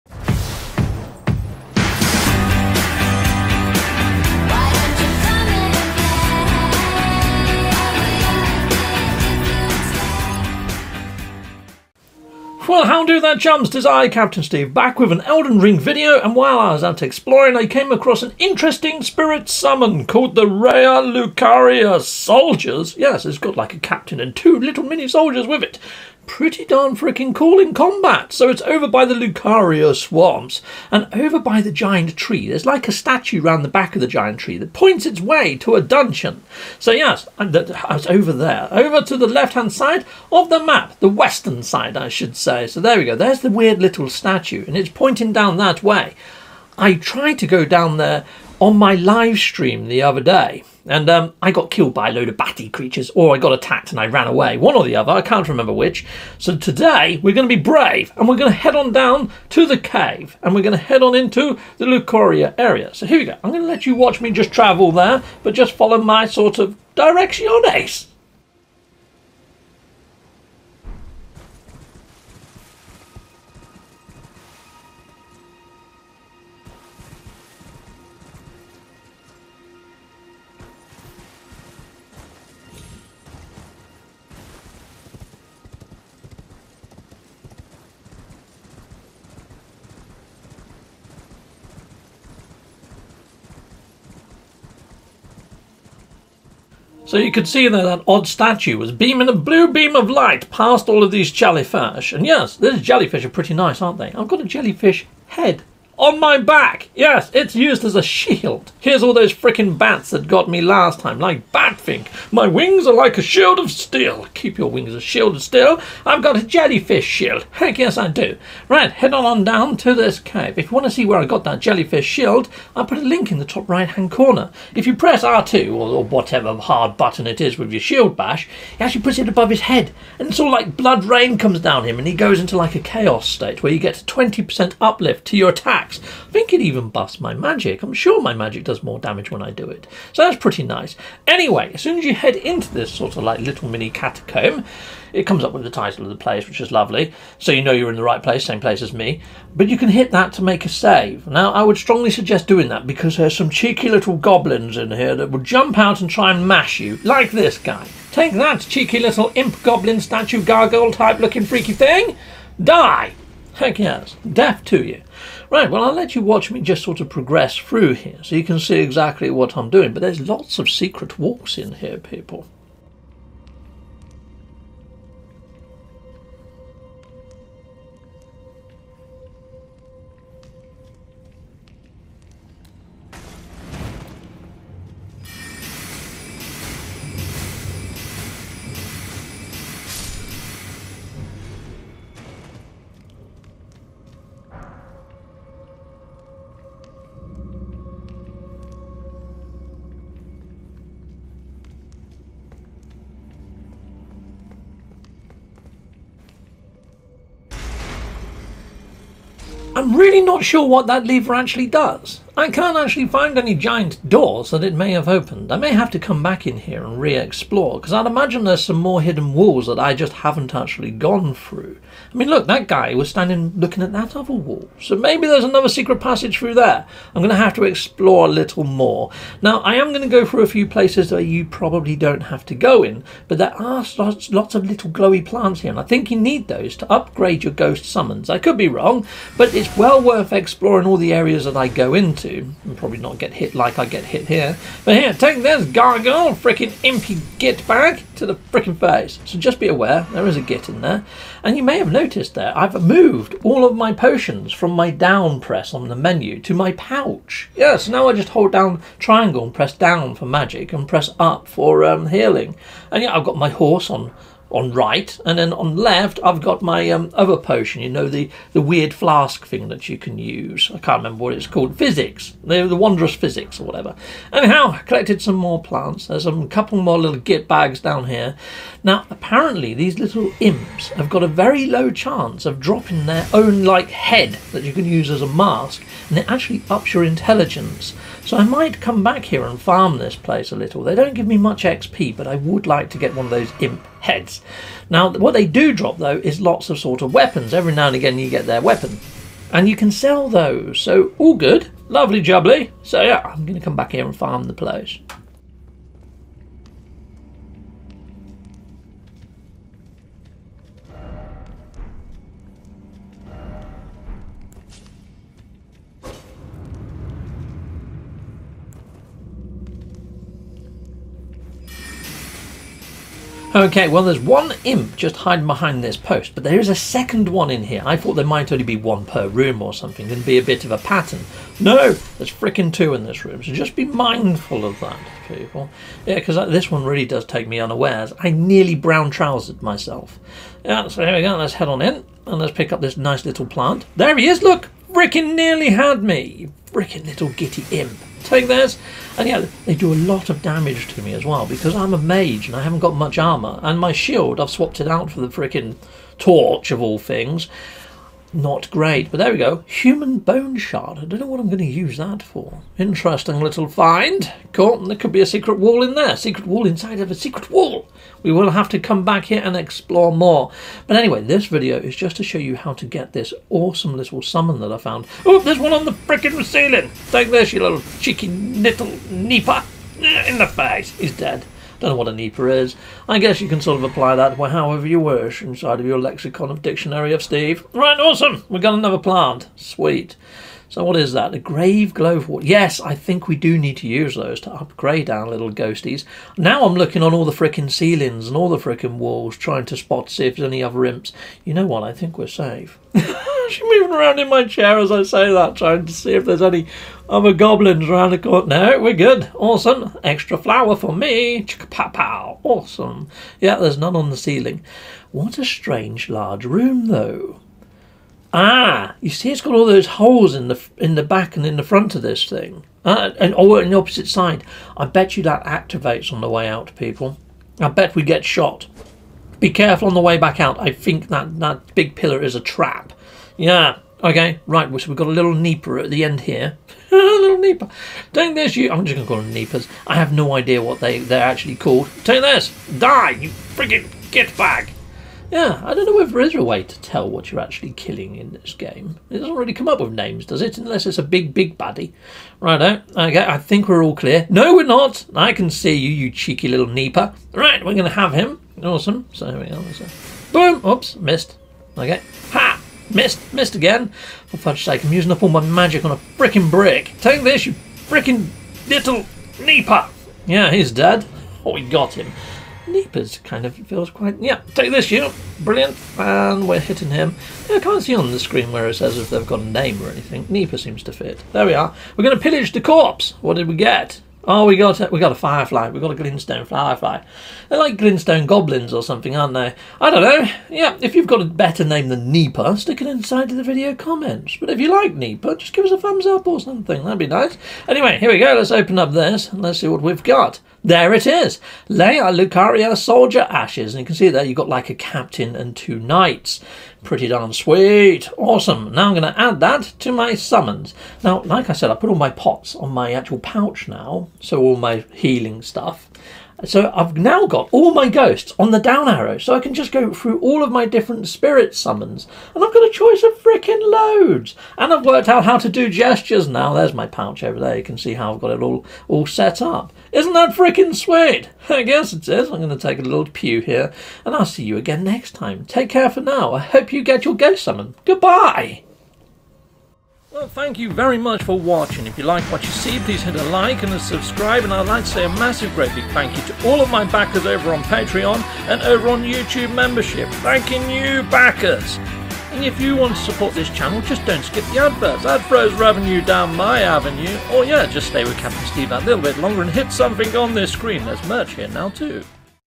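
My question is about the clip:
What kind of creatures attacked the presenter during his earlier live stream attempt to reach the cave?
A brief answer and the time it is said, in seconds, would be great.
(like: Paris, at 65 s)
Bats, at 52 s.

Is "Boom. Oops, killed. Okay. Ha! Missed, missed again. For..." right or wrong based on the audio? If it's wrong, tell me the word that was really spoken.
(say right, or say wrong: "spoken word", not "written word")
wrong: "missed", not "killed".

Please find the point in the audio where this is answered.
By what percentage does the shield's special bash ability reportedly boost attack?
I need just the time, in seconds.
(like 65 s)
134 s.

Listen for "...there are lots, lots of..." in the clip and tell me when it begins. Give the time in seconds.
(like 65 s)
233 s.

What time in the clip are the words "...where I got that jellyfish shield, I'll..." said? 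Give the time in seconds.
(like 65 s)
121 s.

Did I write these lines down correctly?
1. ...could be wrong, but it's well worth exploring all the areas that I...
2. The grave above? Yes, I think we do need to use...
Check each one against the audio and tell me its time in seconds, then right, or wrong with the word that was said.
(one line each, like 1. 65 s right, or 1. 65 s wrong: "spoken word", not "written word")
1. 238 s right
2. 391 s wrong: "glove", not "above".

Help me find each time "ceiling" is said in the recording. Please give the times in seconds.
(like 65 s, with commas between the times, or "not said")
376 s, 397 s, 414 s.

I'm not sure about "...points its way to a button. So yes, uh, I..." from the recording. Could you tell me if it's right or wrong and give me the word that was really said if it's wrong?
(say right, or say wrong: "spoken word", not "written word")
wrong: "dungeon", not "button".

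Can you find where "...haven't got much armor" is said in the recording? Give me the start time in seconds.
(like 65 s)
352 s.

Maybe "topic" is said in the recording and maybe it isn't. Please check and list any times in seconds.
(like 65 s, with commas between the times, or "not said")
not said.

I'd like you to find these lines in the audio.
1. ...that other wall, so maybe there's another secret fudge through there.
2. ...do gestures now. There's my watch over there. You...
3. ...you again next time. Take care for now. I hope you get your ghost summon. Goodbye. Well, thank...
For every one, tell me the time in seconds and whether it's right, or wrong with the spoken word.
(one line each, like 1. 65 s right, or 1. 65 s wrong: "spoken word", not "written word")
1. 223 s wrong: "passage", not "fudge"
2. 525 s wrong: "pouch", not "watch"
3. 534 s right.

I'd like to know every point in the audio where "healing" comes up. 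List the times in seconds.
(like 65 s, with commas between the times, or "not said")
262 s, 514 s.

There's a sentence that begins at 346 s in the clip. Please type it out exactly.
Fricking little gitty imp take this.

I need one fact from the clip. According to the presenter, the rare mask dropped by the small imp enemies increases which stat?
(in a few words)
Intelligence.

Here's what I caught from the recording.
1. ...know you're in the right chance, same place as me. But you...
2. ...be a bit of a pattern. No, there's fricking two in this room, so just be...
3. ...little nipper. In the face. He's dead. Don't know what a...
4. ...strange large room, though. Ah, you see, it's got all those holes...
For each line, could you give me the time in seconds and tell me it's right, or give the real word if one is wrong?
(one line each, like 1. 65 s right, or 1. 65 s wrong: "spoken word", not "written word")
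1. 147 s wrong: "place", not "chance"
2. 330 s right
3. 378 s right
4. 415 s right.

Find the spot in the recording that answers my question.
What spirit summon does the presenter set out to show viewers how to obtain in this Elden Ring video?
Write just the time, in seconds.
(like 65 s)
20 s.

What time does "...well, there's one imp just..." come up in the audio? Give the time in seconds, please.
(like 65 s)
323 s.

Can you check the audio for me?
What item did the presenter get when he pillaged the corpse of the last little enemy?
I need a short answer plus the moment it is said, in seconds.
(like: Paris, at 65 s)
Greenstone firefly, at 485 s.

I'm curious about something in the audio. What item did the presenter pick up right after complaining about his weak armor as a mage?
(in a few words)
Human bone shard.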